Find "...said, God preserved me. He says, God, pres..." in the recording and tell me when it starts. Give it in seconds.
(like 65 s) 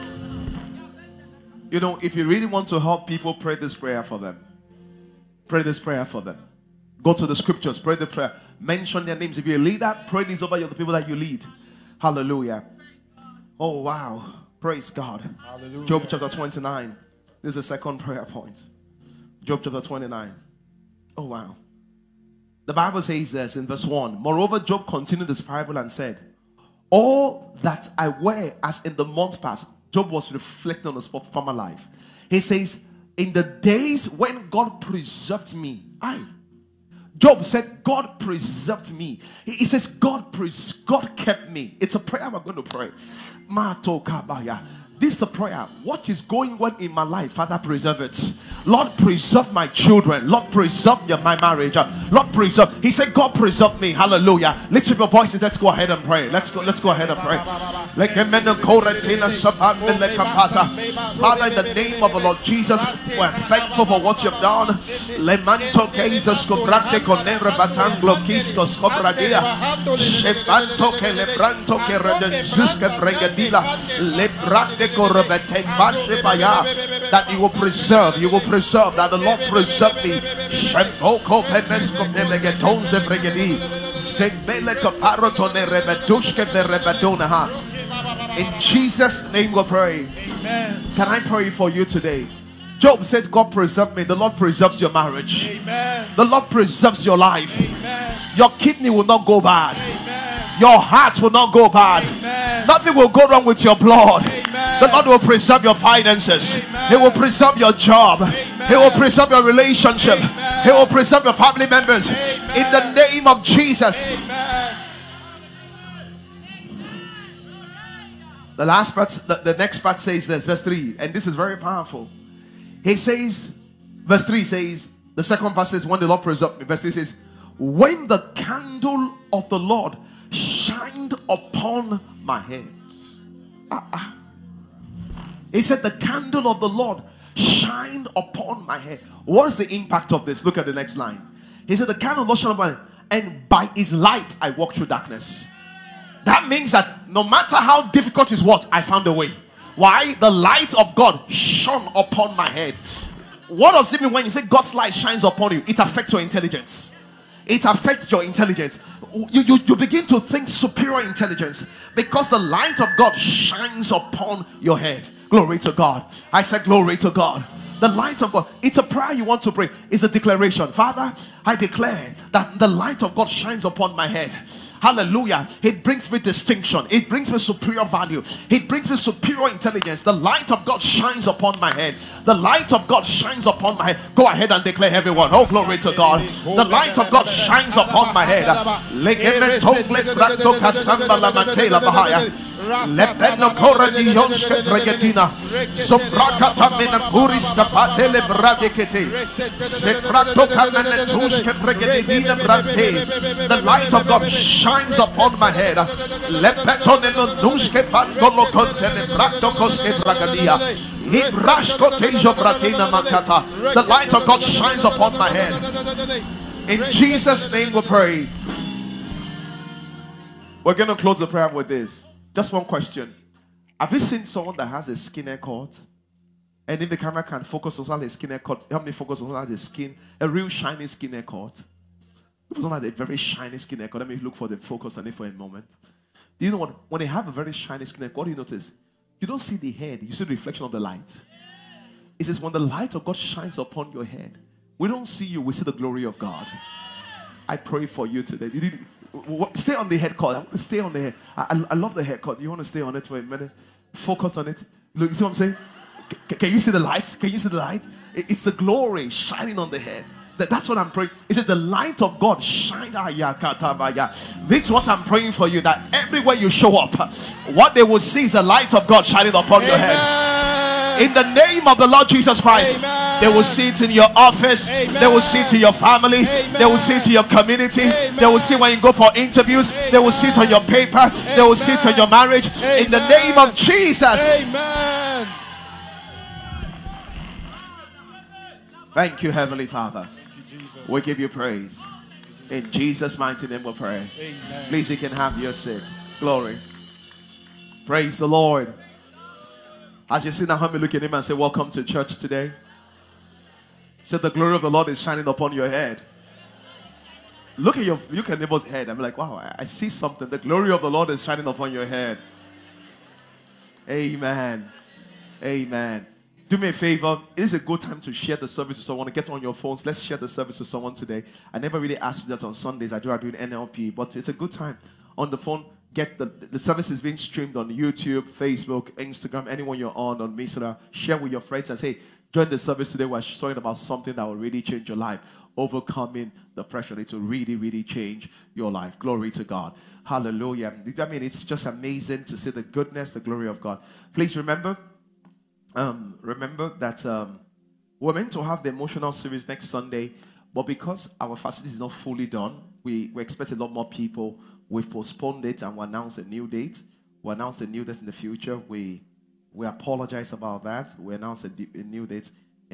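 37 s.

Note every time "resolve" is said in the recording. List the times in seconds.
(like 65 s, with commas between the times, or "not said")
not said.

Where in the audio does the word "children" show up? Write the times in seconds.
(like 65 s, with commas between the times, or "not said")
49 s.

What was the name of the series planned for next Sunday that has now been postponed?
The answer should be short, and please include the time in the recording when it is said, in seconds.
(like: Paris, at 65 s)
emotional series, at 348 s.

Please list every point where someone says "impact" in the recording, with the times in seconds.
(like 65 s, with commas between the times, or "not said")
139 s.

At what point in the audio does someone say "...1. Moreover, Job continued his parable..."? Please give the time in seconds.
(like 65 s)
23 s.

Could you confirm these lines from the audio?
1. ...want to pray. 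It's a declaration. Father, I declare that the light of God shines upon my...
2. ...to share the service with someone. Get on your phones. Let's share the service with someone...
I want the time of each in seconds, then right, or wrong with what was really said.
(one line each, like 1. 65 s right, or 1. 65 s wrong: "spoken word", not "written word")
1. 169 s right
2. 318 s right.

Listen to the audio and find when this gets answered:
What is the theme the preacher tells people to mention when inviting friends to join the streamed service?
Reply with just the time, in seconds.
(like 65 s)
335 s.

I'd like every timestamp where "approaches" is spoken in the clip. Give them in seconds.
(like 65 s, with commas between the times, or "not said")
not said.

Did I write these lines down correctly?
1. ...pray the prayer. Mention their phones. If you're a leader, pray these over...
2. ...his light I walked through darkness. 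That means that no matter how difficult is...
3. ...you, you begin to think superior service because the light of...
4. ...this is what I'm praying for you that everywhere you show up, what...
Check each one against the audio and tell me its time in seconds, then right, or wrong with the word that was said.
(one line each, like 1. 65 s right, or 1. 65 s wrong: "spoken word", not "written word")
1. 7 s wrong: "names", not "phones"
2. 143 s right
3. 159 s wrong: "intelligence", not "service"
4. 264 s right.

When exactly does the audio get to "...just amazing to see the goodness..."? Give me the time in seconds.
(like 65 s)
341 s.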